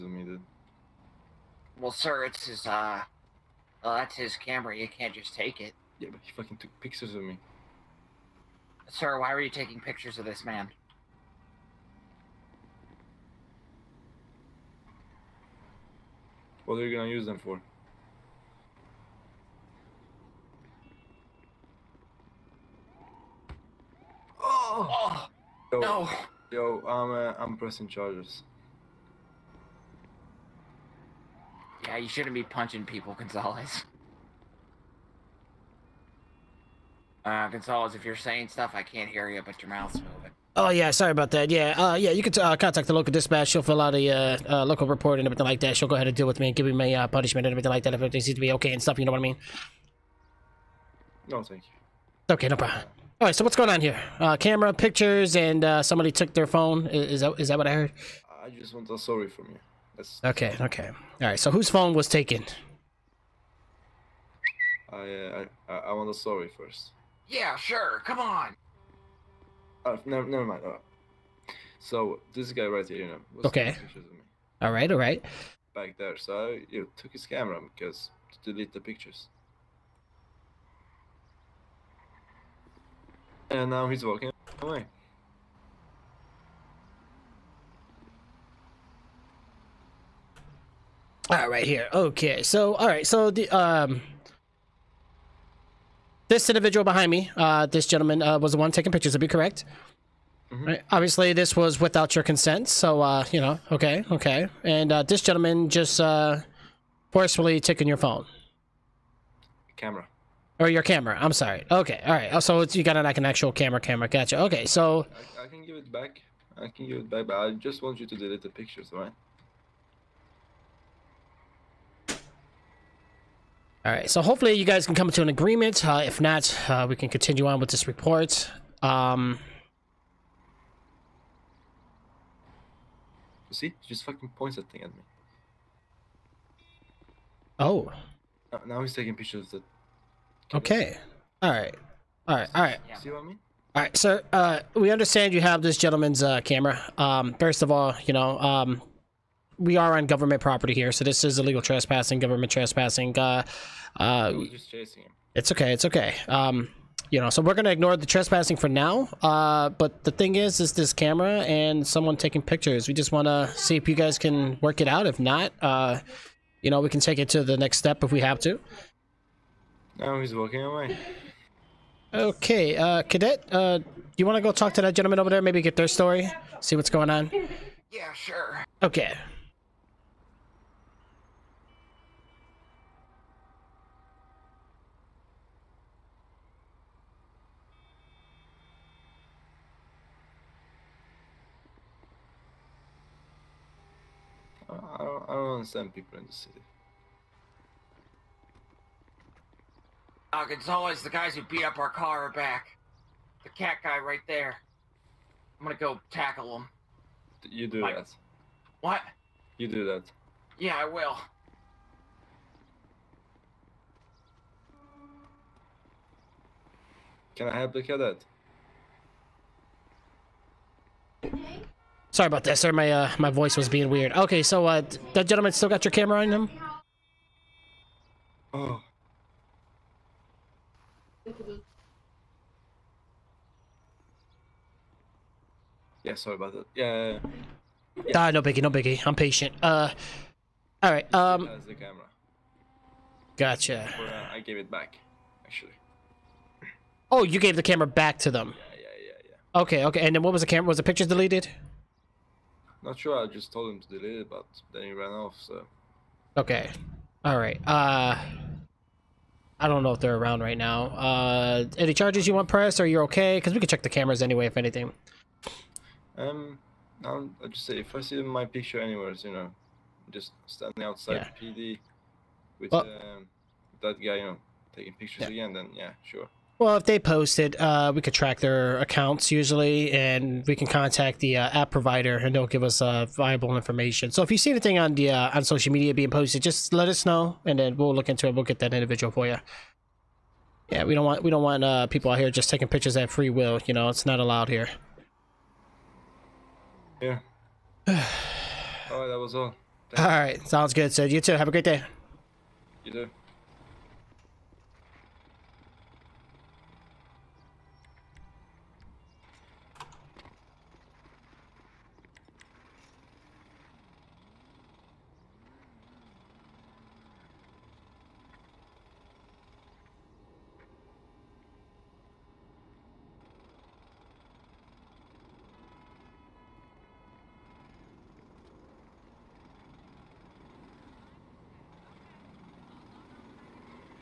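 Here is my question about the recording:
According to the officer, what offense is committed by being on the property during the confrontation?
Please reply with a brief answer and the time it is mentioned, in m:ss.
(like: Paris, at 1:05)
government trespassing, at 2:32.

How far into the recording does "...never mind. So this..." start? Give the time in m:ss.
1:10.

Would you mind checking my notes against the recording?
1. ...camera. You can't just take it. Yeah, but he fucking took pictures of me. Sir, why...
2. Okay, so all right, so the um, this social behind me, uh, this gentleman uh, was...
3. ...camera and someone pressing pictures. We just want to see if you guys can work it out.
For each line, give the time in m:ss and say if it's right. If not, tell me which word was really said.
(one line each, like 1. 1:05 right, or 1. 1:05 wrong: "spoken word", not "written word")
1. 0:04 right
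2. 1:31 wrong: "individual", not "social"
3. 2:40 wrong: "taking", not "pressing".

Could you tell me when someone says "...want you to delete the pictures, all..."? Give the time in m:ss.
1:57.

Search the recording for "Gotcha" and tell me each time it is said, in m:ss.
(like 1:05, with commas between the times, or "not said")
1:54, 4:03.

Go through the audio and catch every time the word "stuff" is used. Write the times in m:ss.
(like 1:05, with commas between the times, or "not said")
0:38, 0:48.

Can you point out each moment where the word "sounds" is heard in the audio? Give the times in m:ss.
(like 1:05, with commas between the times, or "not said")
5:00.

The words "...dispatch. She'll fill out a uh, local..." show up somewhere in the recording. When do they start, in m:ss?
0:43.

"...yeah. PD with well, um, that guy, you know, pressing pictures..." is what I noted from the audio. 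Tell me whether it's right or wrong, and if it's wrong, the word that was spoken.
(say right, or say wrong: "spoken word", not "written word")
wrong: "taking", not "pressing".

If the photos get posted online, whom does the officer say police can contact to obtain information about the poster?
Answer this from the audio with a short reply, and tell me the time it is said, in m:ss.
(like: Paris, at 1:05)
app provider, at 4:41.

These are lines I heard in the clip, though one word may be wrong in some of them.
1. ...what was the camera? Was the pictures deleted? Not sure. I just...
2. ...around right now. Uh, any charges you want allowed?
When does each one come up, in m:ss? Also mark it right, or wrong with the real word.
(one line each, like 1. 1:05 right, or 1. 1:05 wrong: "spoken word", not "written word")
1. 4:10 right
2. 4:20 wrong: "pressed", not "allowed".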